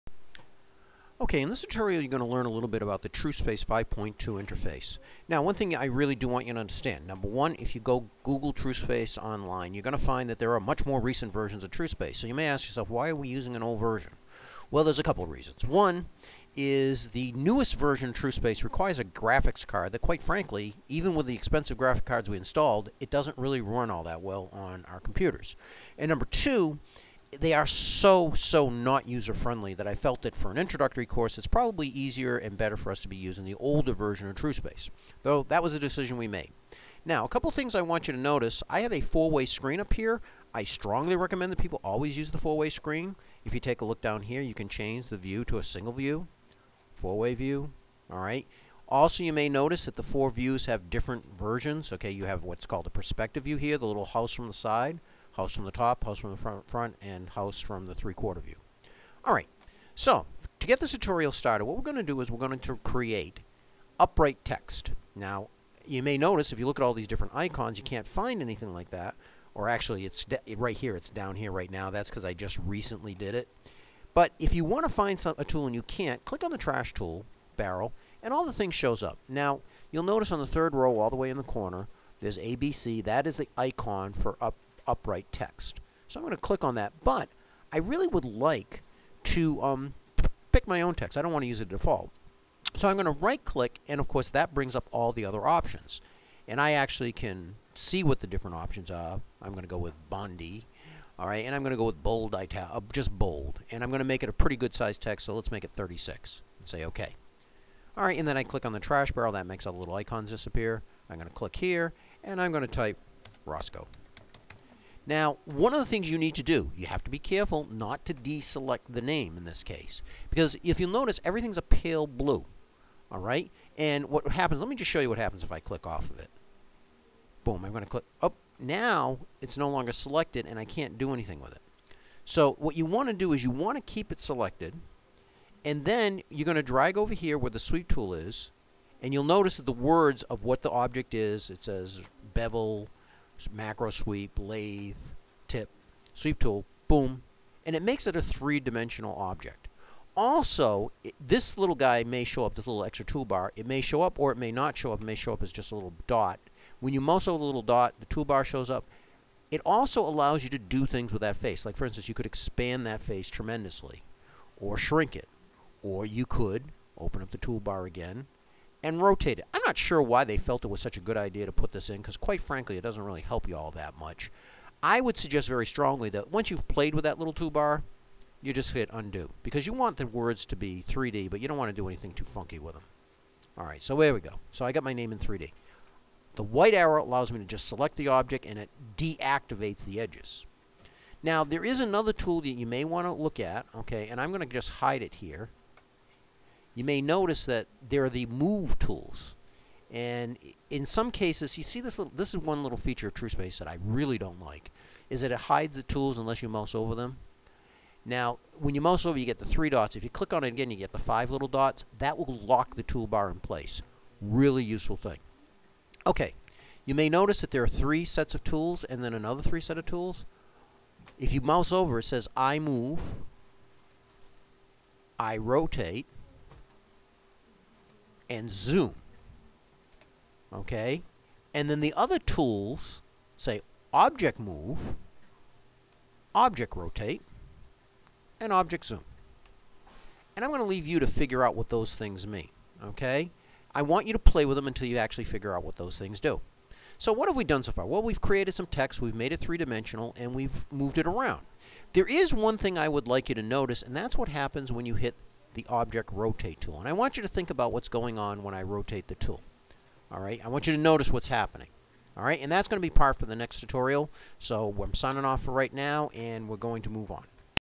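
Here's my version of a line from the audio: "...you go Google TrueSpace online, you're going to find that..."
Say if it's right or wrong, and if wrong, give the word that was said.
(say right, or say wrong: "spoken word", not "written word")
right.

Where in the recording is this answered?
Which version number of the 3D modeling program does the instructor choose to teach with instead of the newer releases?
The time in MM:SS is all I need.
00:03.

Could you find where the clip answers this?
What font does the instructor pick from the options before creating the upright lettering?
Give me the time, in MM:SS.
01:40.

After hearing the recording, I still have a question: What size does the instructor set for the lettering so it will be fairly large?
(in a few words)
36.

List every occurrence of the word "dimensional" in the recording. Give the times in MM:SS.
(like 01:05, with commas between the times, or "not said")
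02:28, 04:09.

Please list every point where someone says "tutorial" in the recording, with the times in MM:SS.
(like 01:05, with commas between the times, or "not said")
00:01, 01:00, 04:23.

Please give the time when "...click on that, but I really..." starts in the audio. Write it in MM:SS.
01:26.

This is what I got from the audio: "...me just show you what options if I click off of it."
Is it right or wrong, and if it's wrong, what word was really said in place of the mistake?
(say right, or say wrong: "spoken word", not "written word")
wrong: "happens", not "options".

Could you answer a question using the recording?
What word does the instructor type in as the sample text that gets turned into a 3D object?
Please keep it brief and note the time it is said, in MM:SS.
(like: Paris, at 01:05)
Roscoe, at 01:53.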